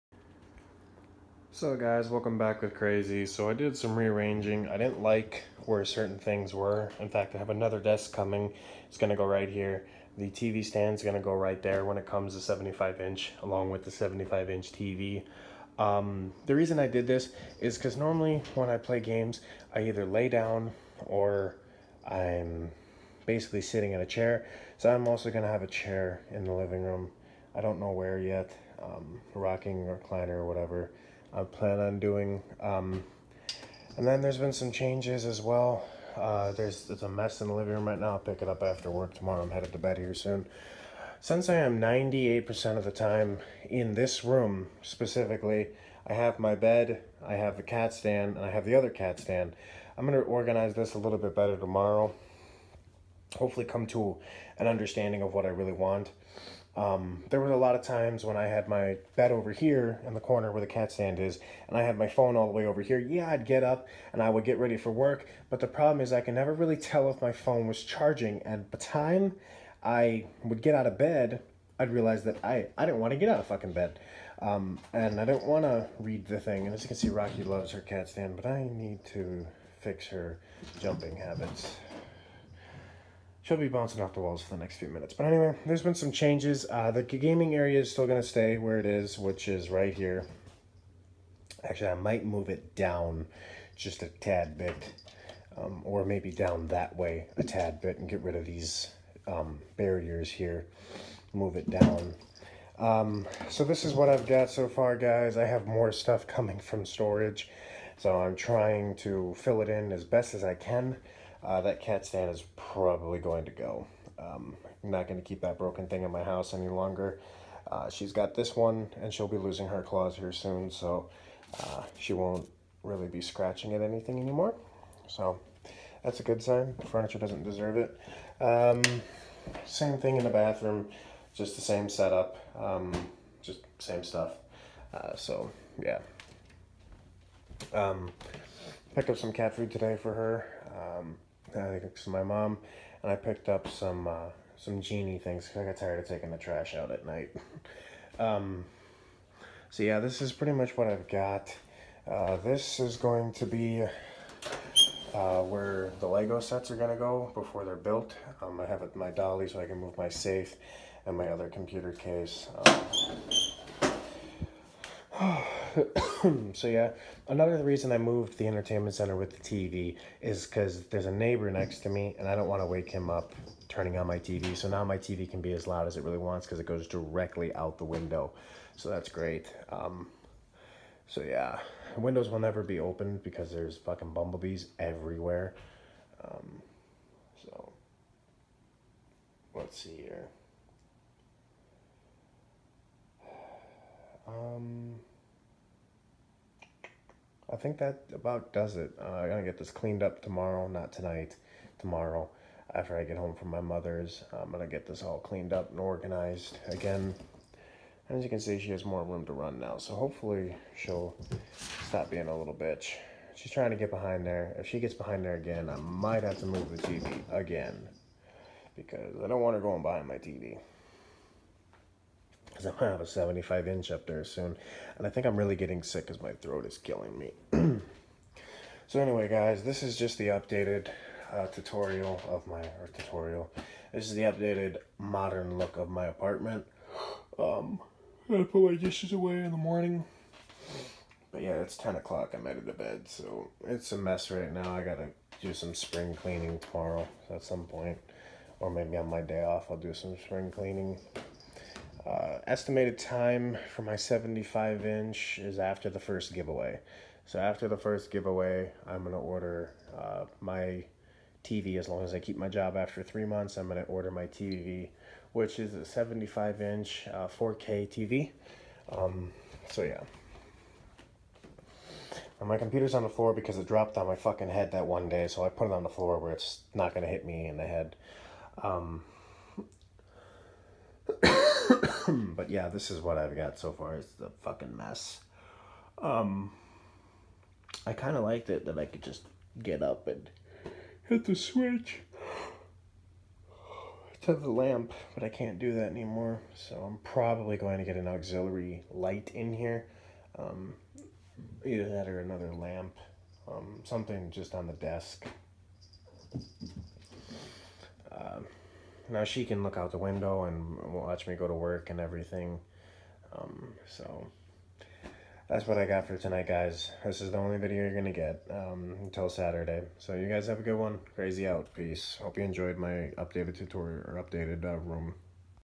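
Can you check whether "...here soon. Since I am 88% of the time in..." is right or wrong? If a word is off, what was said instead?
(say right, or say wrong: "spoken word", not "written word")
wrong: "98", not "88".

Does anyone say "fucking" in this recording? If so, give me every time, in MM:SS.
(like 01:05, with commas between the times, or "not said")
01:13, 03:03, 04:34, 04:44.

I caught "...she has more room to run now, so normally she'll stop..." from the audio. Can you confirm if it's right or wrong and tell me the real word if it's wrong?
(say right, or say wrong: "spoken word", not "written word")
wrong: "hopefully", not "normally".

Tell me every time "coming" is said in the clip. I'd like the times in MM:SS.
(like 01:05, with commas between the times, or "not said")
00:08, 01:46.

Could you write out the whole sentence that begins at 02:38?
Um, I have it, my dolly so I can move my safe and my other computer case.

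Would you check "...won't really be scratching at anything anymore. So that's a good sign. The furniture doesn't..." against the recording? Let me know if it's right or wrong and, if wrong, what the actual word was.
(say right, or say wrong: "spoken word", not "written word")
right.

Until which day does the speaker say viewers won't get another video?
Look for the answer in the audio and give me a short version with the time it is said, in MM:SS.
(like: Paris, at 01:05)
Saturday, at 05:19.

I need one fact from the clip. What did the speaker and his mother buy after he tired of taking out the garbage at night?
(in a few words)
genie things.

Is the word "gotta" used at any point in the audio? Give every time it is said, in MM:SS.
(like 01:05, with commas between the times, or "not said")
03:19, 04:04.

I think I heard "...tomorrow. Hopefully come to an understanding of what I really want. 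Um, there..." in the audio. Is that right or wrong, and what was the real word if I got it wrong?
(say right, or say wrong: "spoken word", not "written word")
right.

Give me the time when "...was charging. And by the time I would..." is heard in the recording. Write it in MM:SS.
01:07.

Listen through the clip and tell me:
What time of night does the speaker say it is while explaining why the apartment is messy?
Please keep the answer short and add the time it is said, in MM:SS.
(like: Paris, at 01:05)
10 o'clock, at 04:01.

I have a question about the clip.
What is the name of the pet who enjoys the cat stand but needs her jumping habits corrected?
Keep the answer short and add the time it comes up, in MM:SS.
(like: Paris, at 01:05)
Rocky, at 01:17.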